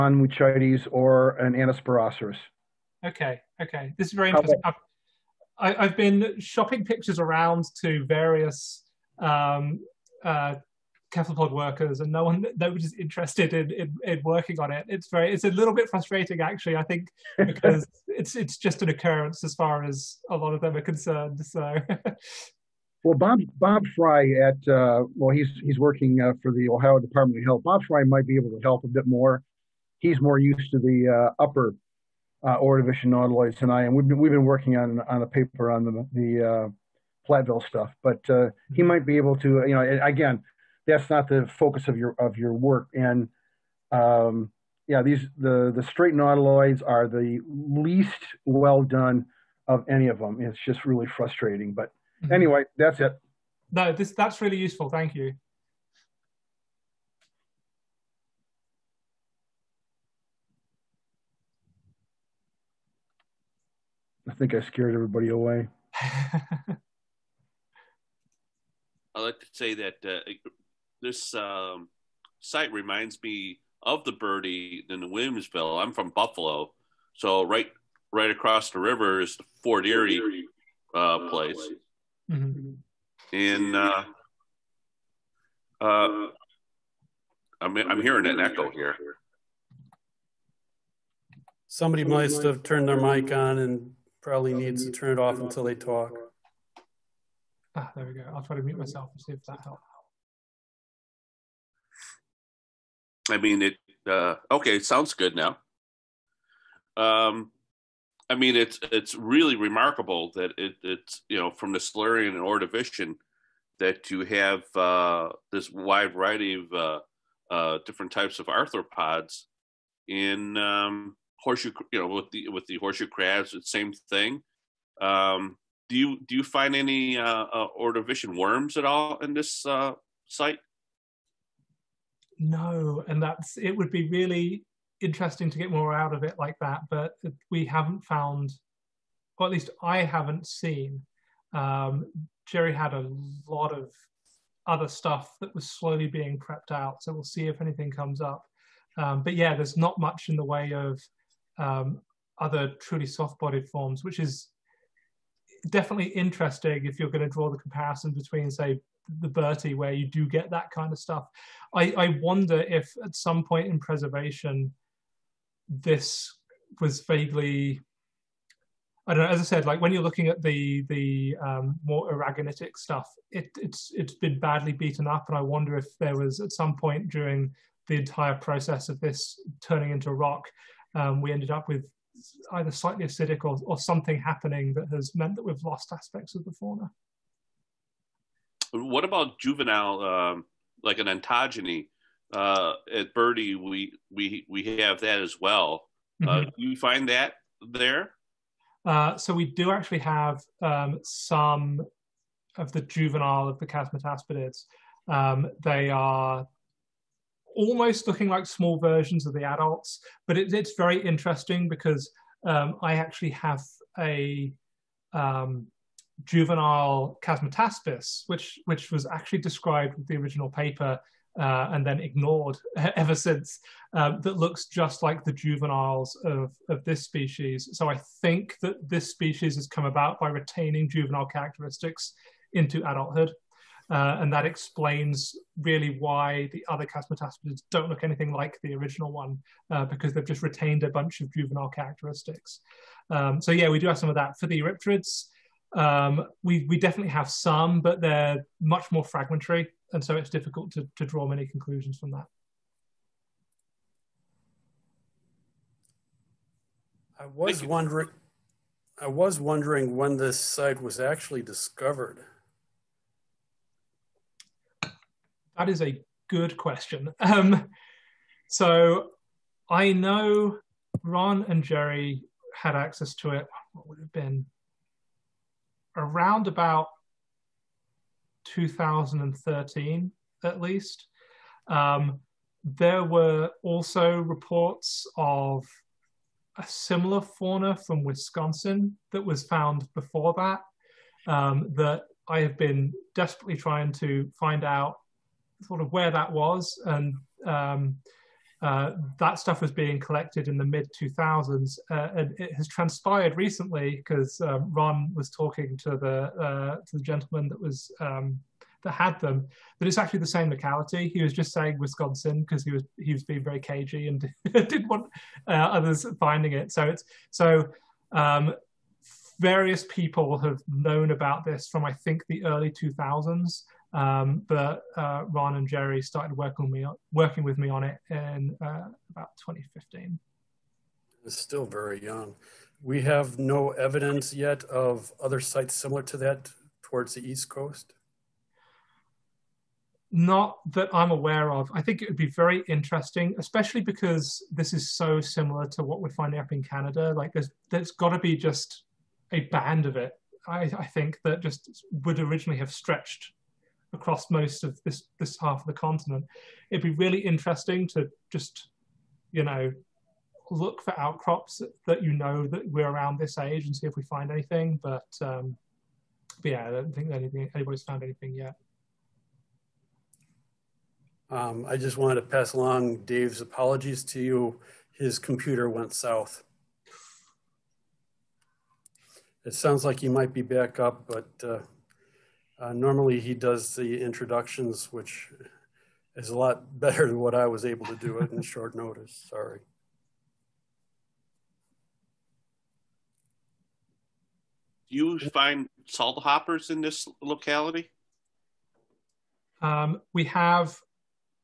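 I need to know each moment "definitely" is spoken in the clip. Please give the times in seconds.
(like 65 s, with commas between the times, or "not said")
155 s, 246 s.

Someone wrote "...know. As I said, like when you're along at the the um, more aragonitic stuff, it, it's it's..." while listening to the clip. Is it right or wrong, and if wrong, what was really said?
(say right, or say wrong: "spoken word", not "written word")
wrong: "looking", not "along".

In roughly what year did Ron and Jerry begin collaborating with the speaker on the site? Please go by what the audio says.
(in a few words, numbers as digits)
2015.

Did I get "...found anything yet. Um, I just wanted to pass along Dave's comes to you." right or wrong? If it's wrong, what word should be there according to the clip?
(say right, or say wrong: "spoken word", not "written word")
wrong: "apologies", not "comes".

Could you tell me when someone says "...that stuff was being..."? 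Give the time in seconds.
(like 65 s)
299 s.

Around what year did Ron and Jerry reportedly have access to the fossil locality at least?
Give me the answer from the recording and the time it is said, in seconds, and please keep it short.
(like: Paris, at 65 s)
2013, at 278 s.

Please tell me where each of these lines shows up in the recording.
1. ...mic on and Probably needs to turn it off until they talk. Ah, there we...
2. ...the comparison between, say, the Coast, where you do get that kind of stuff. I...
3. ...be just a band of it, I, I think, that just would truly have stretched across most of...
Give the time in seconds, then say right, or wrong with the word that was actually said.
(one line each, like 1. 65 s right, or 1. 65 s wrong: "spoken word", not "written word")
1. 92 s right
2. 157 s wrong: "Bertie", not "Coast"
3. 348 s wrong: "originally", not "truly".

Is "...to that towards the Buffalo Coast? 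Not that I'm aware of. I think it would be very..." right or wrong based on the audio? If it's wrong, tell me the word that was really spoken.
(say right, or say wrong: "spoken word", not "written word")
wrong: "East", not "Buffalo".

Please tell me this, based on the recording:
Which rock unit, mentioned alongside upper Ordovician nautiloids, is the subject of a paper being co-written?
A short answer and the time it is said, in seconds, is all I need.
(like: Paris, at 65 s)
Platteville, at 37 s.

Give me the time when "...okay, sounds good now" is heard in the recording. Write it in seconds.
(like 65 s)
104 s.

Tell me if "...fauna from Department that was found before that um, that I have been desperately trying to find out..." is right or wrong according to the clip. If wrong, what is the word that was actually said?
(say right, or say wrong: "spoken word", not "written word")
wrong: "Wisconsin", not "Department".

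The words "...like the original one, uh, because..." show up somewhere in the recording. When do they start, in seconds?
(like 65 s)
238 s.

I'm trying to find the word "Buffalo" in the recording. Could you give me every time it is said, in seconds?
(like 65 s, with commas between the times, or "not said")
76 s.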